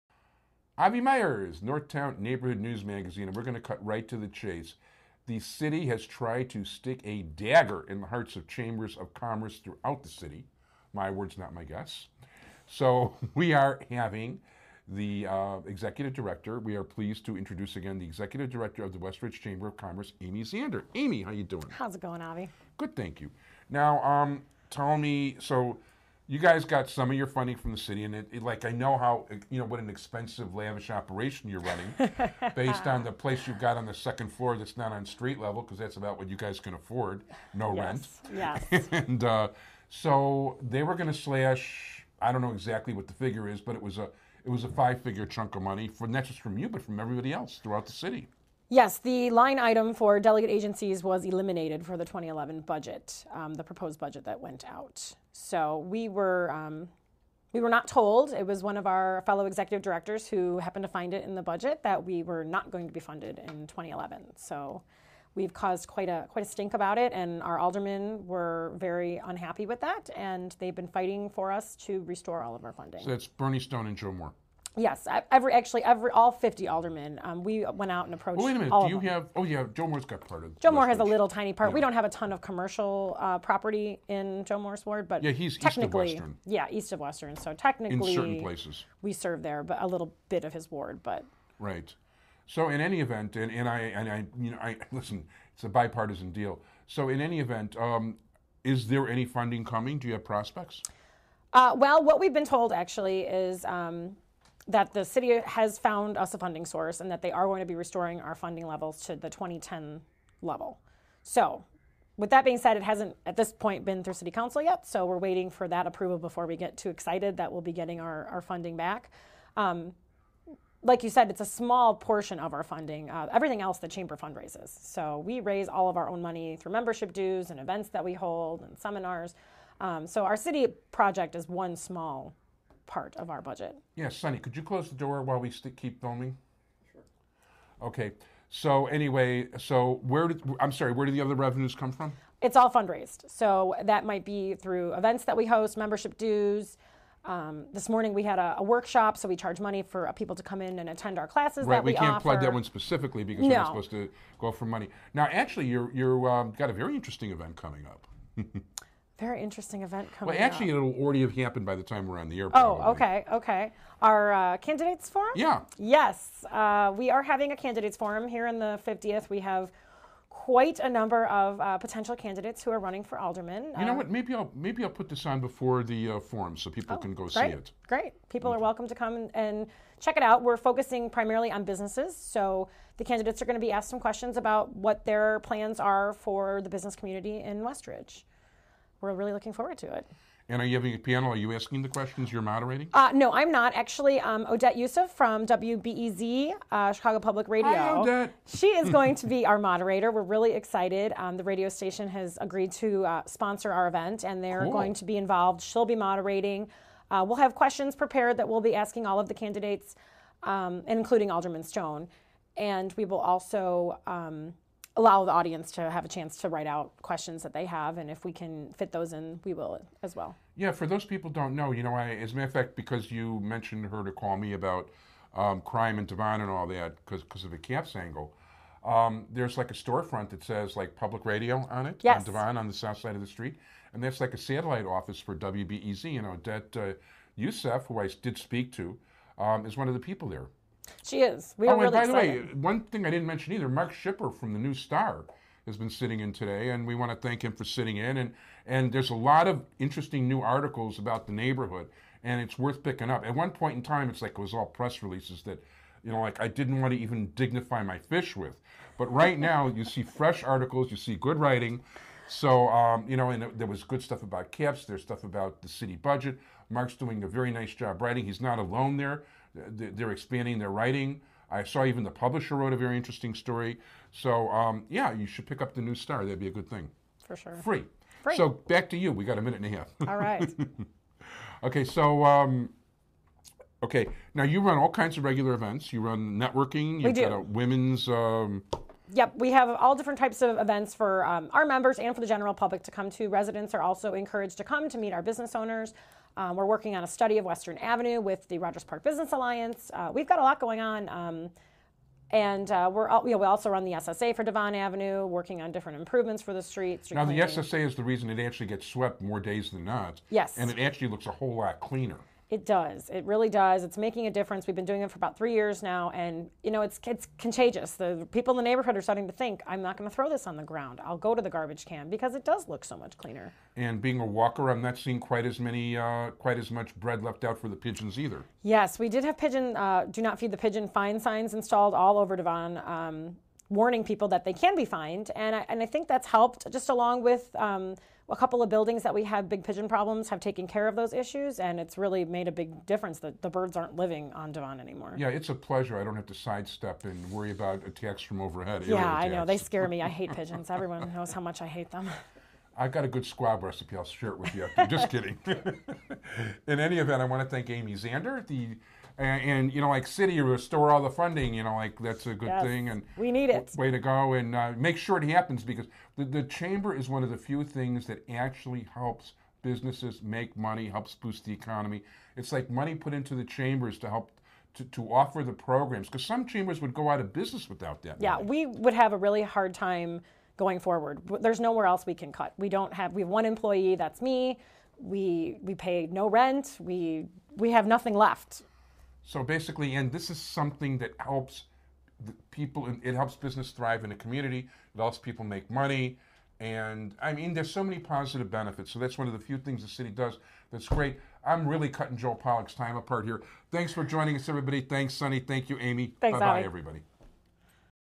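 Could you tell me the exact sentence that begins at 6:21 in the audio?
There's nowhere else we can cut.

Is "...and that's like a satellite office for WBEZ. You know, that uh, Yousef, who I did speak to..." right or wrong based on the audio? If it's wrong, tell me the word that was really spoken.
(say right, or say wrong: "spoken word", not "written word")
right.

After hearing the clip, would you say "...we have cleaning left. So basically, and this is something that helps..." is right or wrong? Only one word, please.
wrong.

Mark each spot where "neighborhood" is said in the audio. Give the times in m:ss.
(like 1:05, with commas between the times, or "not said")
0:02, 4:11, 5:18.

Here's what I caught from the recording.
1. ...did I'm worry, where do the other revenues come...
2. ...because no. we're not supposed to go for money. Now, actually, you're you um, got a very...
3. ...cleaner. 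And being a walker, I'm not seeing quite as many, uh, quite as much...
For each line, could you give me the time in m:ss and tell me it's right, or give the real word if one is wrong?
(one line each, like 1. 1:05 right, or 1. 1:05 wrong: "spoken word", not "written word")
1. 2:20 wrong: "sorry", not "worry"
2. 2:33 right
3. 5:23 right.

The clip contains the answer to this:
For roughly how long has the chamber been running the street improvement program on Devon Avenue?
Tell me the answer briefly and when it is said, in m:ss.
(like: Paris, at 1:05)
about three years, at 5:15.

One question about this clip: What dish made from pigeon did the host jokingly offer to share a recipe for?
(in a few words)
squab.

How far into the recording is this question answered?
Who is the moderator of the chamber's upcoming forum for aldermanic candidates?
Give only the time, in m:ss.
3:14.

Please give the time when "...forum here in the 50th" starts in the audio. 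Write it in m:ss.
2:47.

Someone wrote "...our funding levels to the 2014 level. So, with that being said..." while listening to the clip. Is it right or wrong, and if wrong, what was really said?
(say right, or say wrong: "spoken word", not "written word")
wrong: "2010", not "2014".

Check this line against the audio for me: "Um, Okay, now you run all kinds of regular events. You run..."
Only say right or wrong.
right.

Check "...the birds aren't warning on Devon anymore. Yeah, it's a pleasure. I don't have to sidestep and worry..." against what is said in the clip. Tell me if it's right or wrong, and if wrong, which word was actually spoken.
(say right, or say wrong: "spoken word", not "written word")
wrong: "living", not "warning".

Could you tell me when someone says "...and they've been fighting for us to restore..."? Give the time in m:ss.
1:10.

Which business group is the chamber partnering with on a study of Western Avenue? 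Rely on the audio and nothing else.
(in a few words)
Rogers Park Business Alliance.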